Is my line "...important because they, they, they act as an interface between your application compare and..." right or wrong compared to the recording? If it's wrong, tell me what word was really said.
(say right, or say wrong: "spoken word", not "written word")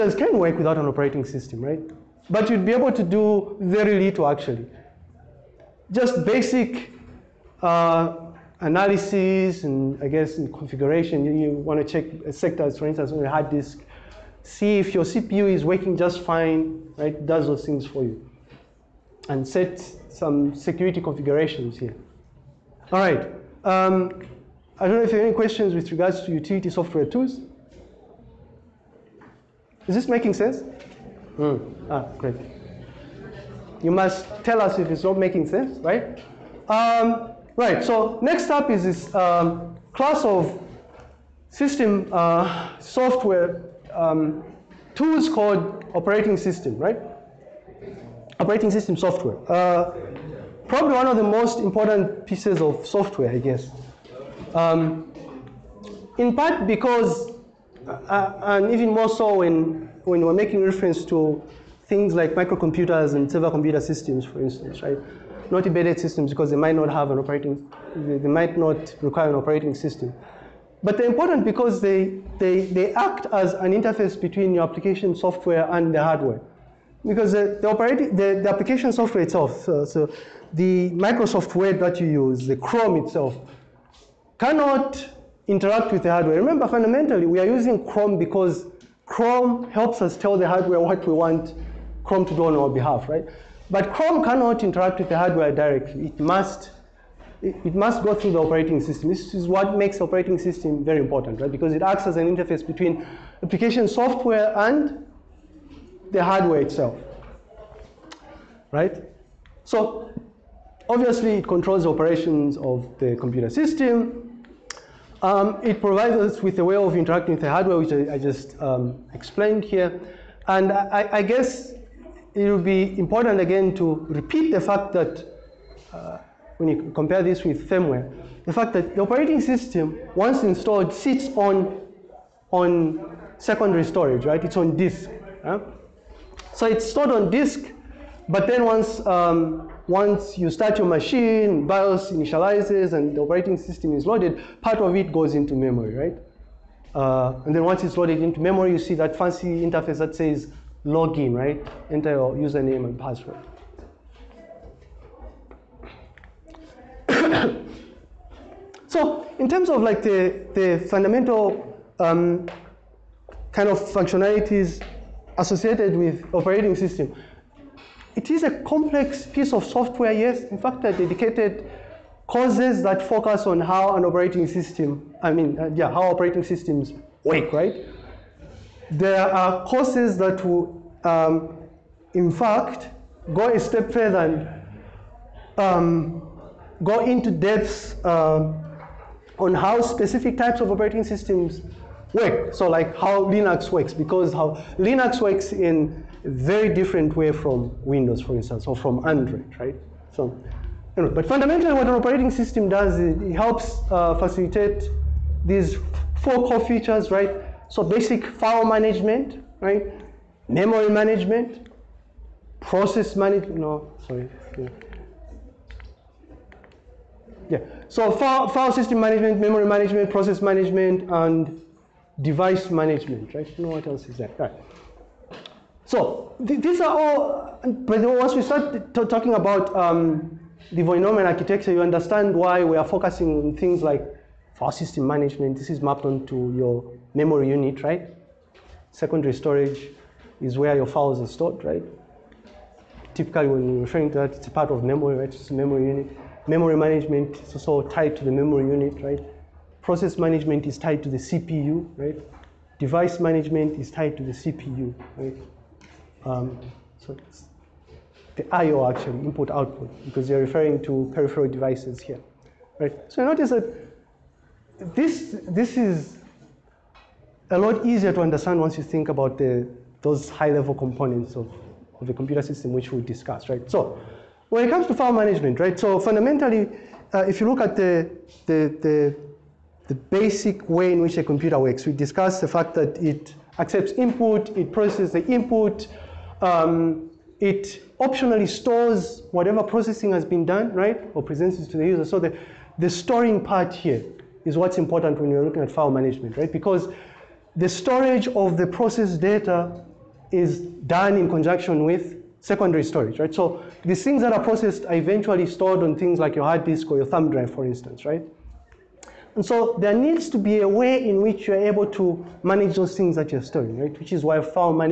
wrong: "software", not "compare".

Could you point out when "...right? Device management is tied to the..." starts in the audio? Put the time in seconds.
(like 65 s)
251 s.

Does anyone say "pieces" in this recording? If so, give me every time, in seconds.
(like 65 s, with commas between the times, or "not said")
52 s, 169 s.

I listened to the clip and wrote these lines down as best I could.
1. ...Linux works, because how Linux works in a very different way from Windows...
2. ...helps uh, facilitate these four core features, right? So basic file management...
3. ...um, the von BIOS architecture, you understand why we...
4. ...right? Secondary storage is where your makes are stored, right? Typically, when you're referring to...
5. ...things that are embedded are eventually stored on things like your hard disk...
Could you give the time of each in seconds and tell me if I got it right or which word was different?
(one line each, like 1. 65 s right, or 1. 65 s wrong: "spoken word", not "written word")
1. 193 s right
2. 203 s right
3. 229 s wrong: "Neumann", not "BIOS"
4. 237 s wrong: "files", not "makes"
5. 304 s wrong: "processed", not "embedded".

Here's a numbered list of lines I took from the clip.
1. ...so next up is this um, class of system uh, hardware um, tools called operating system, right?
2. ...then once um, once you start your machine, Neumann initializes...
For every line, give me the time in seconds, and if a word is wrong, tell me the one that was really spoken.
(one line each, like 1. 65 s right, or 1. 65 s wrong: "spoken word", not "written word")
1. 37 s wrong: "software", not "hardware"
2. 138 s wrong: "BIOS", not "Neumann".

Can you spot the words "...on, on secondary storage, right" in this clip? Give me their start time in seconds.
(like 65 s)
131 s.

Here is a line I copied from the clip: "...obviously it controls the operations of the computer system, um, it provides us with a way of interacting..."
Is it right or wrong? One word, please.
right.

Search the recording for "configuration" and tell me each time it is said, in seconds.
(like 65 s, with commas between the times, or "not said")
10 s, 21 s.